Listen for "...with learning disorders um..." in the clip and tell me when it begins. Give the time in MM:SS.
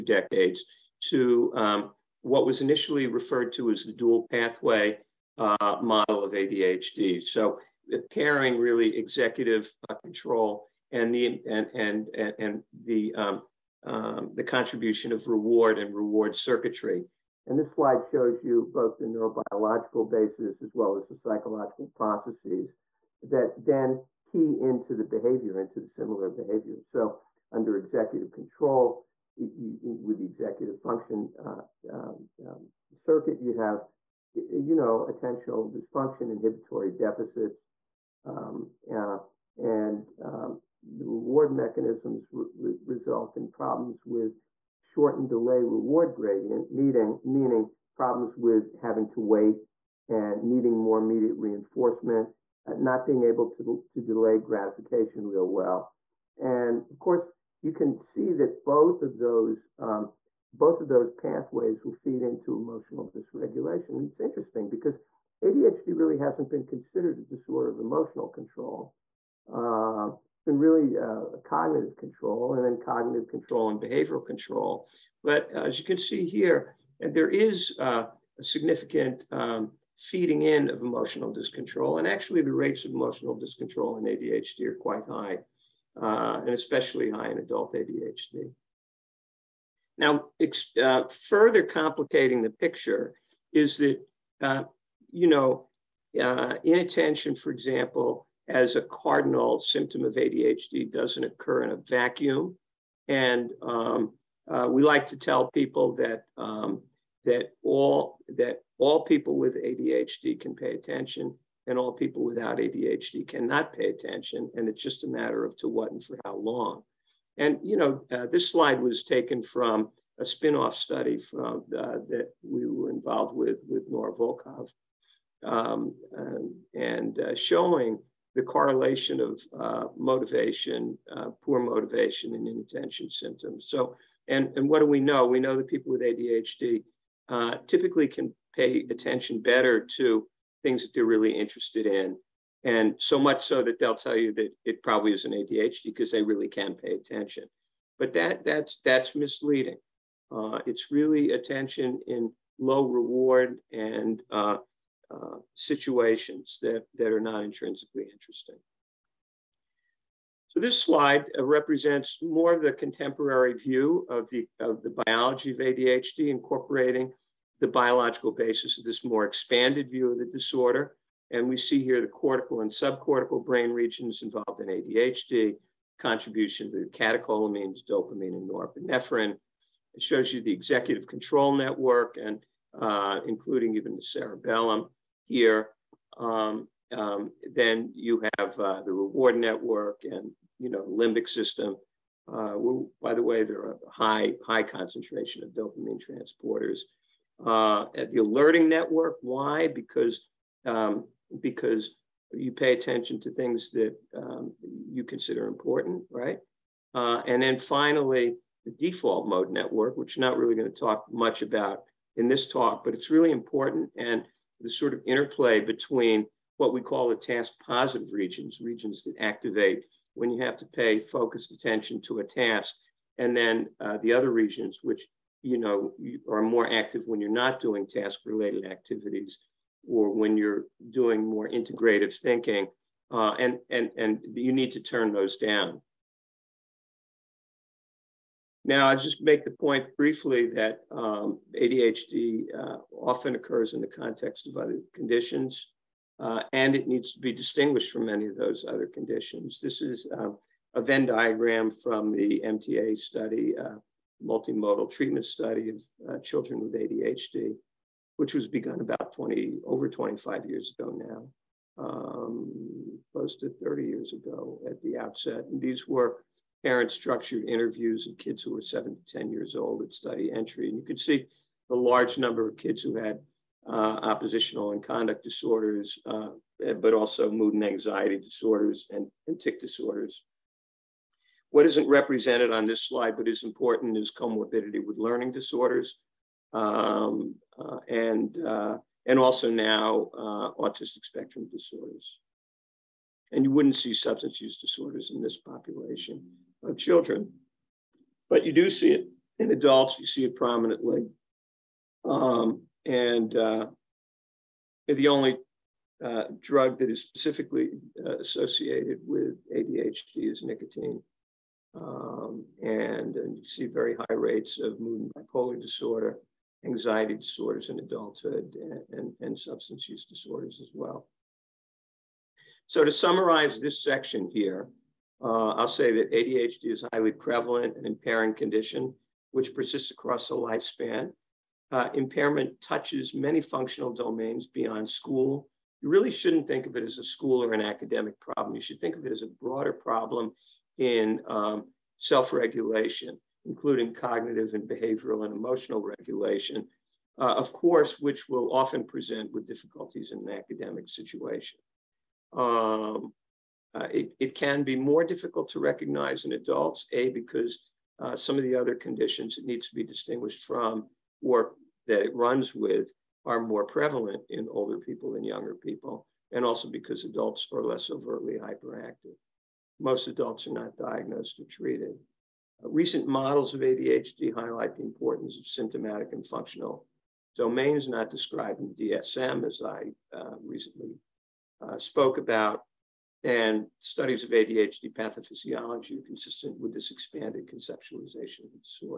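04:44.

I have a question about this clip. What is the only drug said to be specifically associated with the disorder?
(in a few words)
Nicotine.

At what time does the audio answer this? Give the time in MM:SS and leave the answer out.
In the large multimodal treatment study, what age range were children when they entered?
04:28.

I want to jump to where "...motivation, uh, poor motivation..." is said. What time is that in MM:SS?
02:09.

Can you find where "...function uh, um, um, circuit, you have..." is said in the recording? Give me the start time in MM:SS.
00:30.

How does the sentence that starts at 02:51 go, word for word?
And we see here the cortical and subcortical brain regions involved in ADHD, contribution to catecholamines, dopamine, and norepinephrine.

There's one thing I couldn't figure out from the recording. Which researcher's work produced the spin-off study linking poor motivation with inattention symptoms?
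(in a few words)
Nora Volkow.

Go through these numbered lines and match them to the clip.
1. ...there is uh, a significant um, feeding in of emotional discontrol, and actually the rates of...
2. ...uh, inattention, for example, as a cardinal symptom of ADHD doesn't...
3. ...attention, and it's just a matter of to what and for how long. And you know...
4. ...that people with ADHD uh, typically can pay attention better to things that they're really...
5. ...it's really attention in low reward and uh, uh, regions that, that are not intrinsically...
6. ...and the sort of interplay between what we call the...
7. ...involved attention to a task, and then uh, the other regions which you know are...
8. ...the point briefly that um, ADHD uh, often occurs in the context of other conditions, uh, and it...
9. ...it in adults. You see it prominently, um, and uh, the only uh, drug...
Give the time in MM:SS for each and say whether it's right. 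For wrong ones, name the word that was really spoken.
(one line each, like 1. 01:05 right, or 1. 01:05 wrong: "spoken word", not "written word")
1. 01:17 right
2. 01:36 right
3. 01:53 right
4. 02:15 right
5. 02:30 wrong: "situations", not "regions"
6. 03:33 right
7. 03:41 wrong: "focused", not "involved"
8. 03:59 right
9. 04:58 right.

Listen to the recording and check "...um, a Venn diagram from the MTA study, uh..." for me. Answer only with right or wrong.
right.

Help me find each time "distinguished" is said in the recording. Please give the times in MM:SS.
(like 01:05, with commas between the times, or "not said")
04:07, 05:59.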